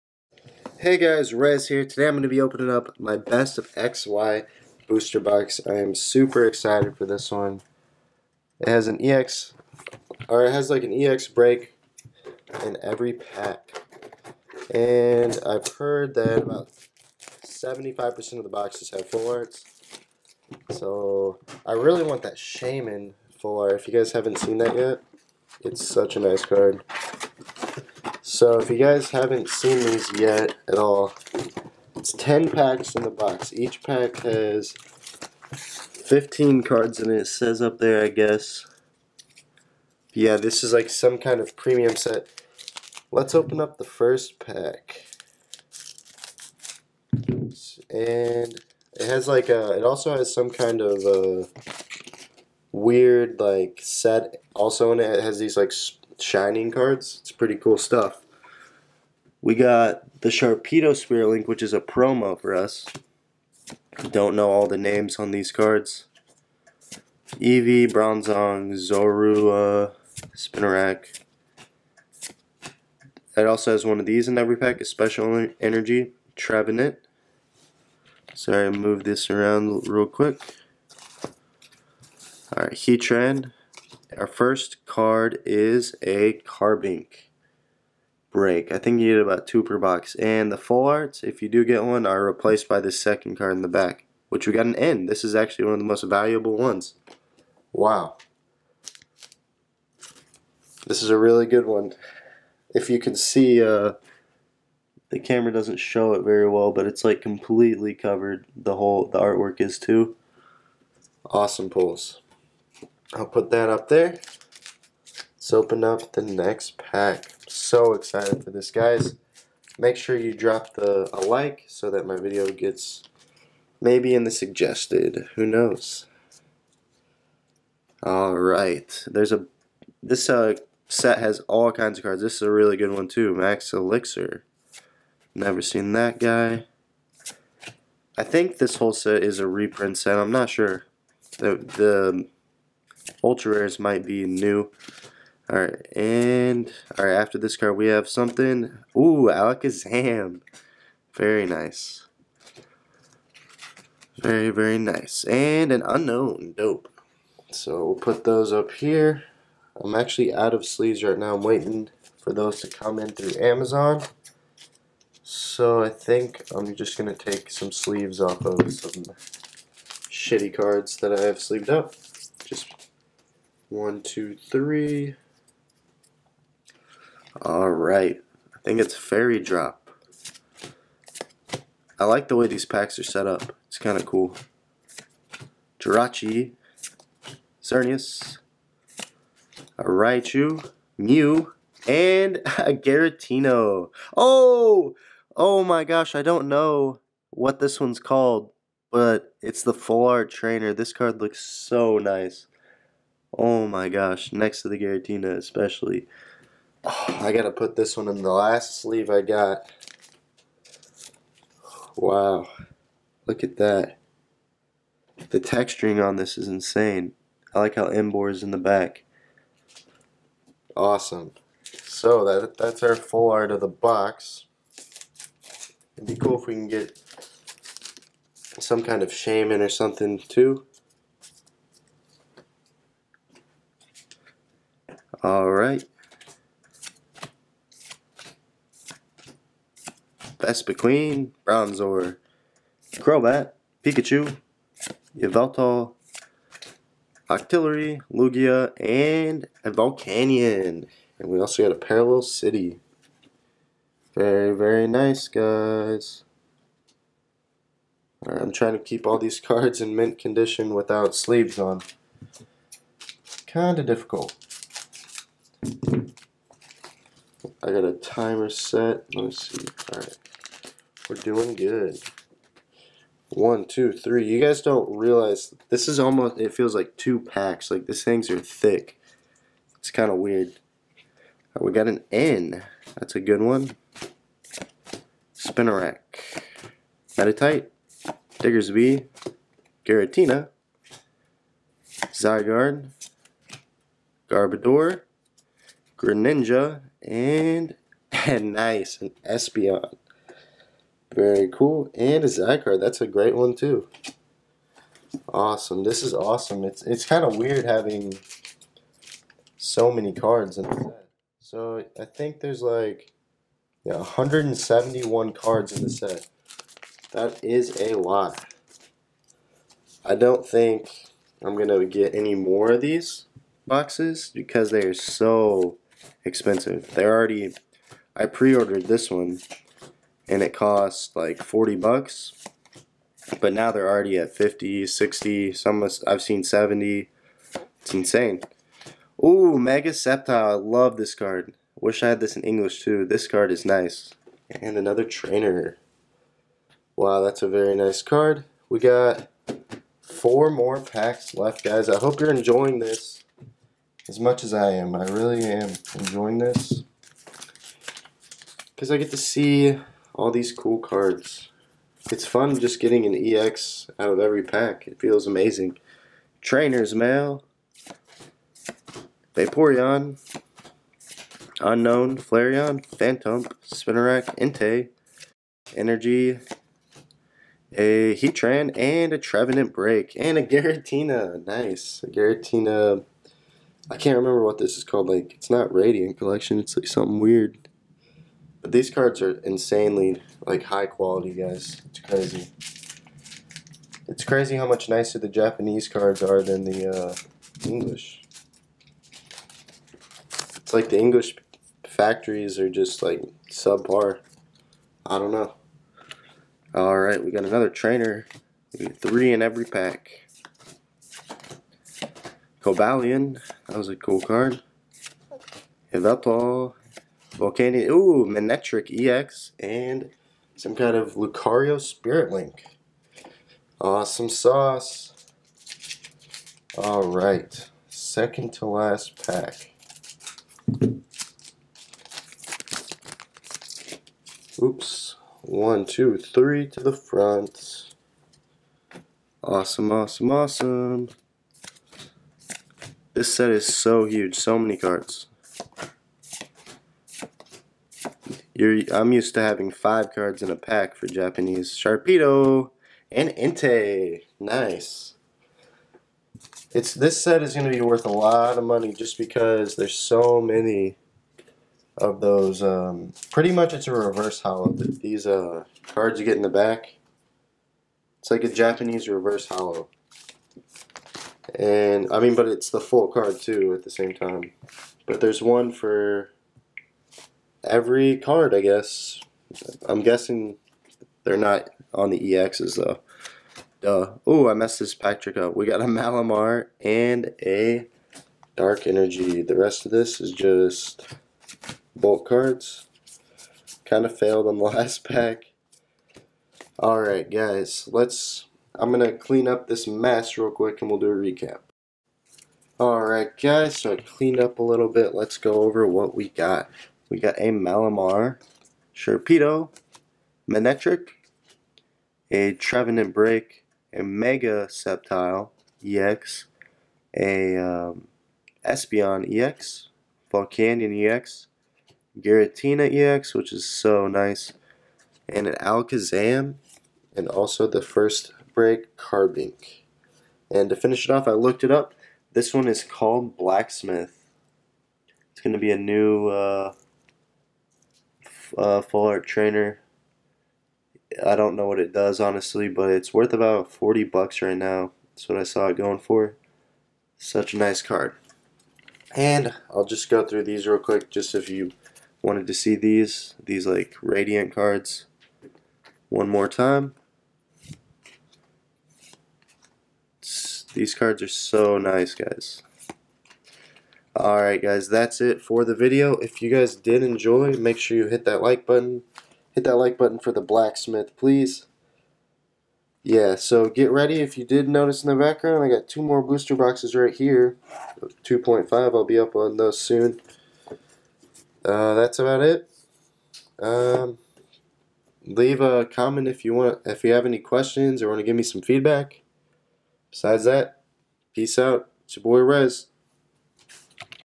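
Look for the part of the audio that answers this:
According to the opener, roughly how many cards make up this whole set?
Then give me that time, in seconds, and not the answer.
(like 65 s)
313 s.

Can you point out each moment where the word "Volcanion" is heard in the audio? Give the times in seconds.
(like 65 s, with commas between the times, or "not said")
249 s, 417 s, 520 s.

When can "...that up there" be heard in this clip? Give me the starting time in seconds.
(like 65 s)
113 s.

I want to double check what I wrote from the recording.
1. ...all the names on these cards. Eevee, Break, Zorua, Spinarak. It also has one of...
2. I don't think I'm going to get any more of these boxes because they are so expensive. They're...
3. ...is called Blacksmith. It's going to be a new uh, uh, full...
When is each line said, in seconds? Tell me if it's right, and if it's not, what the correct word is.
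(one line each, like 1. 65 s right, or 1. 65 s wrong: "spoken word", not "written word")
1. 64 s wrong: "Bronzong", not "Break"
2. 320 s right
3. 532 s right.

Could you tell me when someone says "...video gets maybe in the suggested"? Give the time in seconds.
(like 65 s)
122 s.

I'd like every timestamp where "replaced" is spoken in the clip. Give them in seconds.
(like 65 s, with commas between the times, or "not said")
92 s.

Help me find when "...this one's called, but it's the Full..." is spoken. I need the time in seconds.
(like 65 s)
197 s.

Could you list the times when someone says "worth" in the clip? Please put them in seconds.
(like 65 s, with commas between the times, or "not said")
457 s, 543 s.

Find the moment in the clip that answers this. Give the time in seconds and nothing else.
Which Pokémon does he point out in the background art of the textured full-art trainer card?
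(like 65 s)
217 s.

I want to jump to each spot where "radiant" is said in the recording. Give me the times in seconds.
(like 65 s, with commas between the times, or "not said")
385 s, 554 s.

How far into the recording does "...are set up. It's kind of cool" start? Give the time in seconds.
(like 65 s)
182 s.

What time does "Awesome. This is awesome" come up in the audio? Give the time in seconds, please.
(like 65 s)
305 s.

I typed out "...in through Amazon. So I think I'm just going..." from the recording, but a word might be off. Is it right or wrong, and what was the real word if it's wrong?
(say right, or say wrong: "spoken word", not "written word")
right.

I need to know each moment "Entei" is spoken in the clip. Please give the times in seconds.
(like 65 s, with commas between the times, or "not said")
374 s, 453 s.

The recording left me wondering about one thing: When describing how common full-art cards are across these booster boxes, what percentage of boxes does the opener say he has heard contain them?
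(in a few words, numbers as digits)
75%.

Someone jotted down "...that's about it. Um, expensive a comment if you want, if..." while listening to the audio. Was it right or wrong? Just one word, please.
wrong.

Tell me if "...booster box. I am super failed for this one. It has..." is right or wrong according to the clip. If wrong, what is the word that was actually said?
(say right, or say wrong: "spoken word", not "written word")
wrong: "excited", not "failed".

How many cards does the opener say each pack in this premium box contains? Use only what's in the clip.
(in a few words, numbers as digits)
15.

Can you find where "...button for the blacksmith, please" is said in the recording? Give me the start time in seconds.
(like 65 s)
569 s.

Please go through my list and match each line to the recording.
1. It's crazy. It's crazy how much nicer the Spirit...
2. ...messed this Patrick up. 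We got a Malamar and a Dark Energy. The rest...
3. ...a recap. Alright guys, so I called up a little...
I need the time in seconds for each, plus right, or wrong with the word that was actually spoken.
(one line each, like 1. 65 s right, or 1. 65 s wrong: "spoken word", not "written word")
1. 391 s wrong: "Japanese", not "Spirit"
2. 484 s right
3. 501 s wrong: "cleaned", not "called".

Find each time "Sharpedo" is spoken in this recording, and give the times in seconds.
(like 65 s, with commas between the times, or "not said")
60 s, 451 s, 508 s.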